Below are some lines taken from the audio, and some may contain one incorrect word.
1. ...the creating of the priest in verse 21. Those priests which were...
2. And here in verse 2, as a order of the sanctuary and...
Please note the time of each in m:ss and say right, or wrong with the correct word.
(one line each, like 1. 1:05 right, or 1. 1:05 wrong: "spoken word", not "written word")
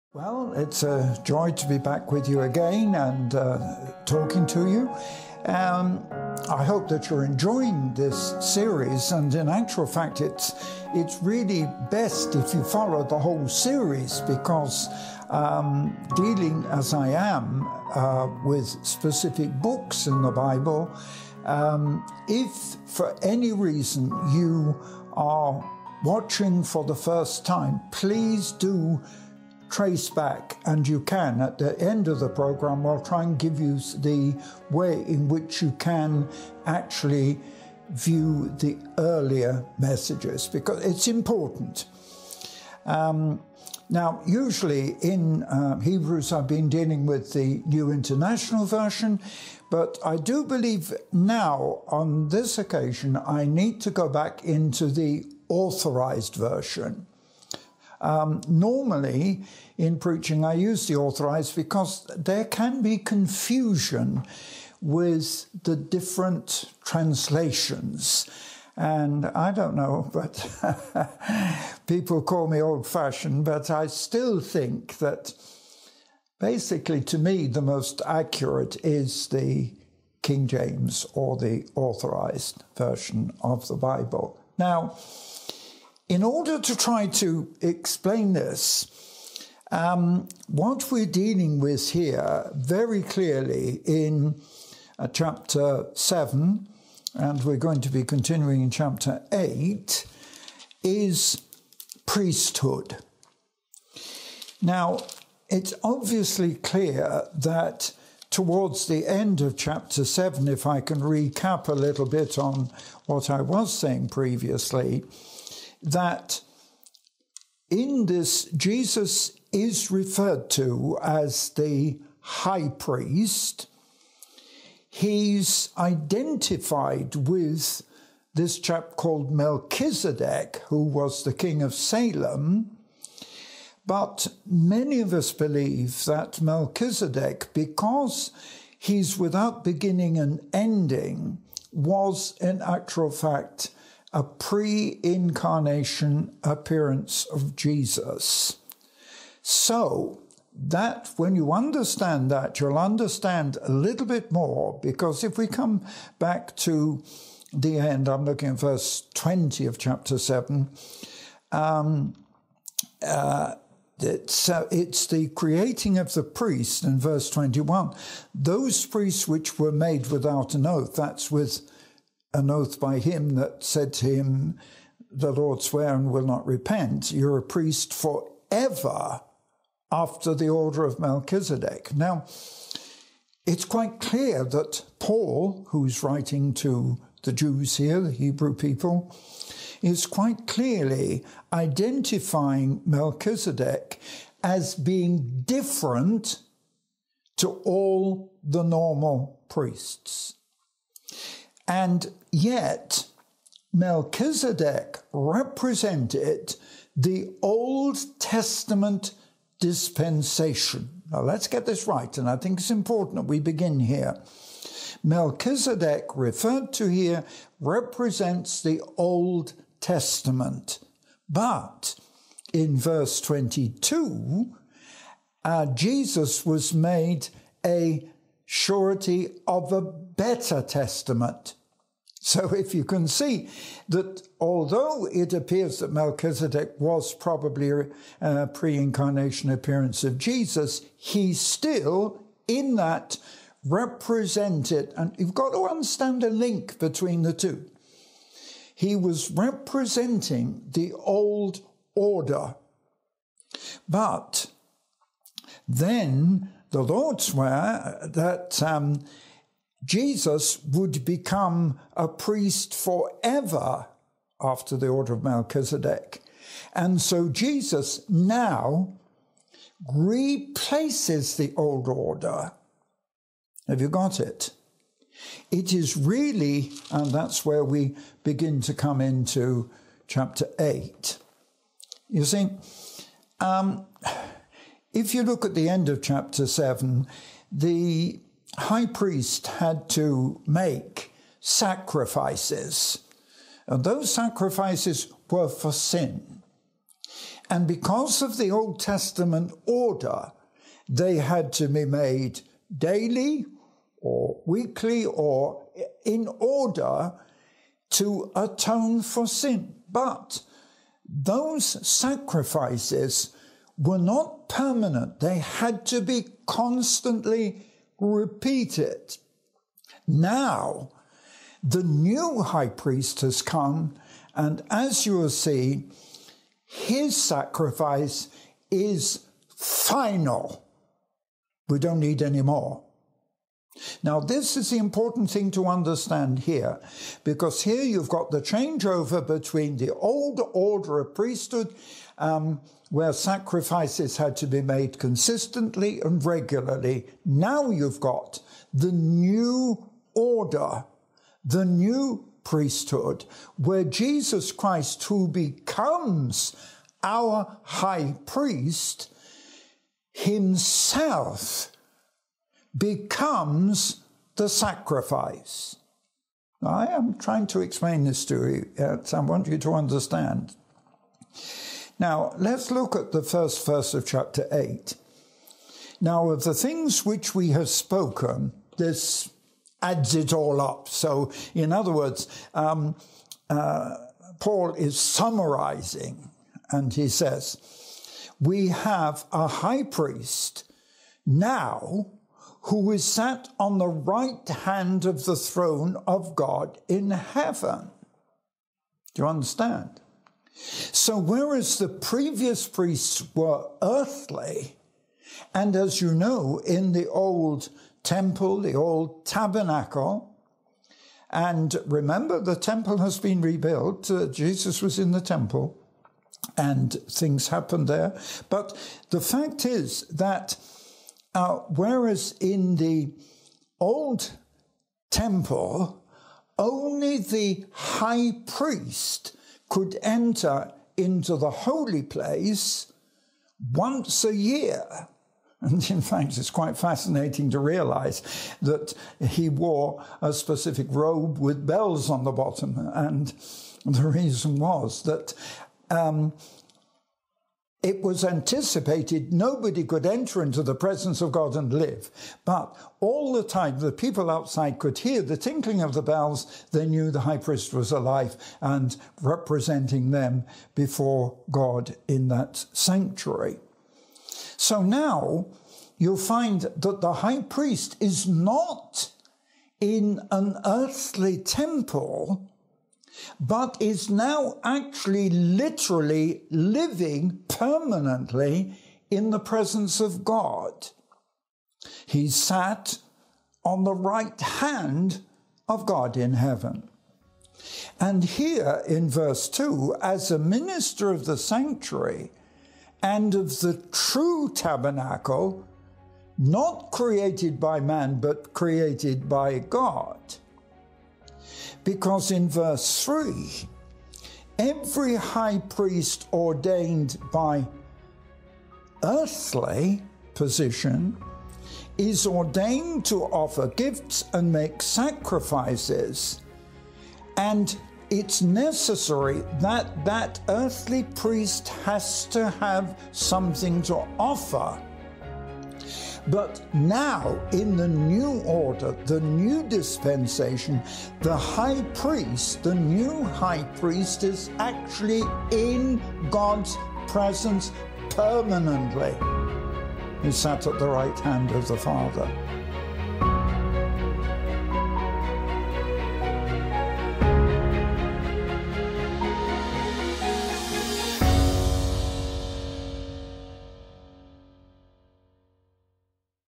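1. 2:45 right
2. 8:07 wrong: "minister", not "order".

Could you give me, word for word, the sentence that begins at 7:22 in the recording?
And the reason was that um, it was anticipated nobody could enter into the presence of God and live.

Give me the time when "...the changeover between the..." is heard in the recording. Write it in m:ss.
5:38.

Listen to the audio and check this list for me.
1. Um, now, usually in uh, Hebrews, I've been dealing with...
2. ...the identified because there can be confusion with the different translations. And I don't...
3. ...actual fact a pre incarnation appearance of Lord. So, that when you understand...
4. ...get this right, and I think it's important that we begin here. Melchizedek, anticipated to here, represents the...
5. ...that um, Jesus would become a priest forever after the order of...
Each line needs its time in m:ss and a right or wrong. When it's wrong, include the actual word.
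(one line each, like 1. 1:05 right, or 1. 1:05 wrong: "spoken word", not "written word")
1. 0:42 right
2. 1:00 wrong: "authorized", not "identified"
3. 2:22 wrong: "Jesus", not "Lord"
4. 3:31 wrong: "referred", not "anticipated"
5. 4:18 right.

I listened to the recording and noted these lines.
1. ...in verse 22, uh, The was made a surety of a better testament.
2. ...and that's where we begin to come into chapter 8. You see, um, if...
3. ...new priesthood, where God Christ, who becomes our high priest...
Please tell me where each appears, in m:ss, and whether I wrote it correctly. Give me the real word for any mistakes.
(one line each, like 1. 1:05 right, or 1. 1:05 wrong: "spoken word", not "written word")
1. 3:42 wrong: "Jesus", not "The"
2. 4:36 right
3. 5:51 wrong: "Jesus", not "God".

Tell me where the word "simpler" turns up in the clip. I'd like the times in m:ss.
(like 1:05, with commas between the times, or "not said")
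not said.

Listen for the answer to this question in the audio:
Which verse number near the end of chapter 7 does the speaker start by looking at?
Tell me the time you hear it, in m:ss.
2:38.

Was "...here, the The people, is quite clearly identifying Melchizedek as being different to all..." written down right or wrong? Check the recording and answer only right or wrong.
wrong.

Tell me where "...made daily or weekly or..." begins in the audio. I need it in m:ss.
5:01.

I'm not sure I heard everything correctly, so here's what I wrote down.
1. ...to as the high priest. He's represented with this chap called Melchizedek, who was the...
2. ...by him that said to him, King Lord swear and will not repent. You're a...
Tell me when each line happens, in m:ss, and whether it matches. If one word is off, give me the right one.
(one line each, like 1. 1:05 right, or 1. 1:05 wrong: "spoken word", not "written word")
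1. 2:00 wrong: "identified", not "represented"
2. 2:52 wrong: "The", not "King".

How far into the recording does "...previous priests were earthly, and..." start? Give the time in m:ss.
6:41.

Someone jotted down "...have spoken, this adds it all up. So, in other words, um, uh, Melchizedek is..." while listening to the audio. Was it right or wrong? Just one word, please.
wrong.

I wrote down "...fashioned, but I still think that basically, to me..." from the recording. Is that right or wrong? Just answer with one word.
right.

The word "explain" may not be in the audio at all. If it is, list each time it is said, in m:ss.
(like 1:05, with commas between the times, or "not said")
1:27, 6:07.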